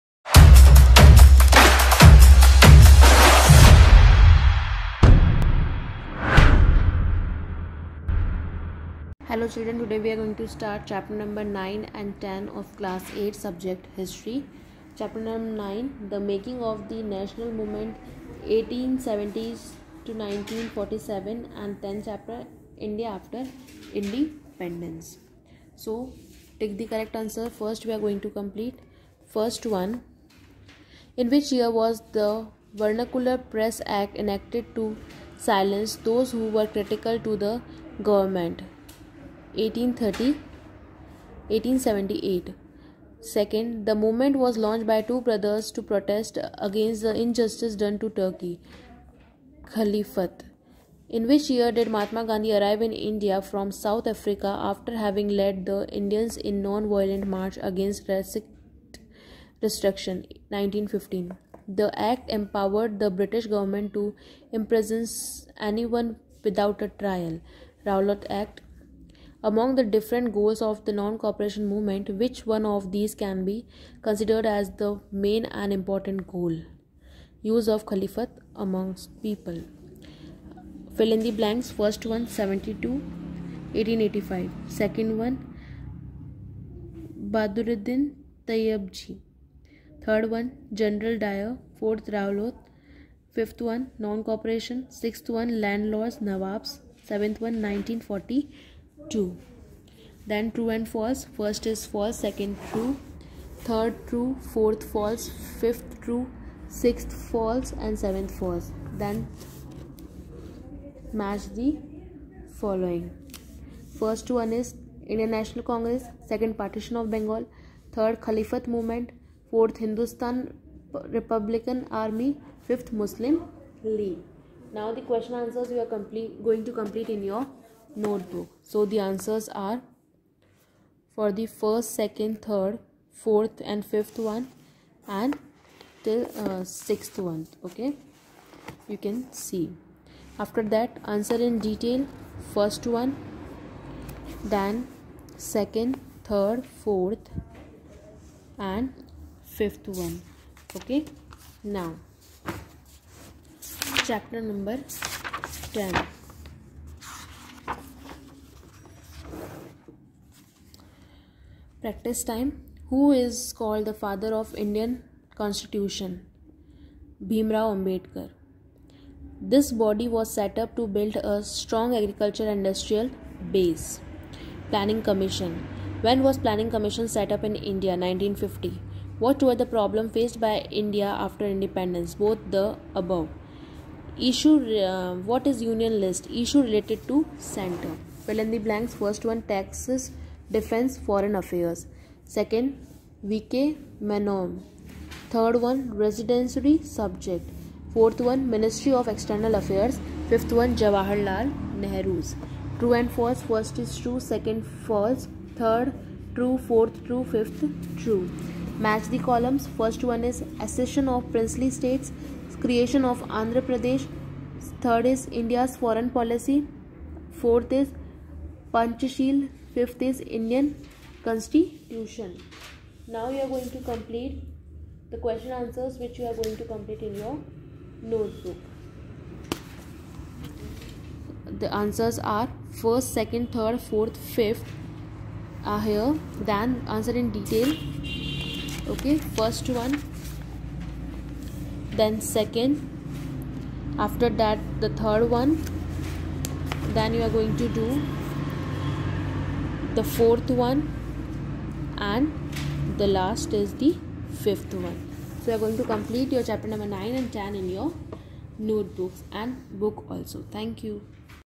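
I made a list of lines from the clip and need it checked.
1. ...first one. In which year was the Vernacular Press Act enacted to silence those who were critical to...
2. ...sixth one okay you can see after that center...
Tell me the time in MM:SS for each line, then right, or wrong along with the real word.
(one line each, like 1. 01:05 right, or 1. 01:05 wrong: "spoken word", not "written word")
1. 00:29 right
2. 02:16 wrong: "answer", not "center".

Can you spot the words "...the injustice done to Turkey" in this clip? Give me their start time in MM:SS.
00:47.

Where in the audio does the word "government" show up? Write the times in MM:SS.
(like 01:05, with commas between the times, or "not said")
00:38, 01:03.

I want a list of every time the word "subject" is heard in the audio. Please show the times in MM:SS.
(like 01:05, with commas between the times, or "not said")
00:13, 03:16.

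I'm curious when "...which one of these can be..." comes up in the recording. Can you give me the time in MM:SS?
01:12.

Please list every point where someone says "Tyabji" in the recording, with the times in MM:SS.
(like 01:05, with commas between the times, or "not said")
01:28.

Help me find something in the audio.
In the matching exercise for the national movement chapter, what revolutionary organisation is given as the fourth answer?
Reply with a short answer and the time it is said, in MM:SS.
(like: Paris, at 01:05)
Hindustan Republican Army, at 01:59.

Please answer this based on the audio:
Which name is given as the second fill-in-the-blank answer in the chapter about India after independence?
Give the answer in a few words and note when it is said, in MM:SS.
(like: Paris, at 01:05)
VK Menon, at 03:13.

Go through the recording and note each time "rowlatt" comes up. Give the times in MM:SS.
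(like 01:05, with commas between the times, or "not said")
01:07, 01:32.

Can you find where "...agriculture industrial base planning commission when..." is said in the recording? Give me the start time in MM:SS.
02:52.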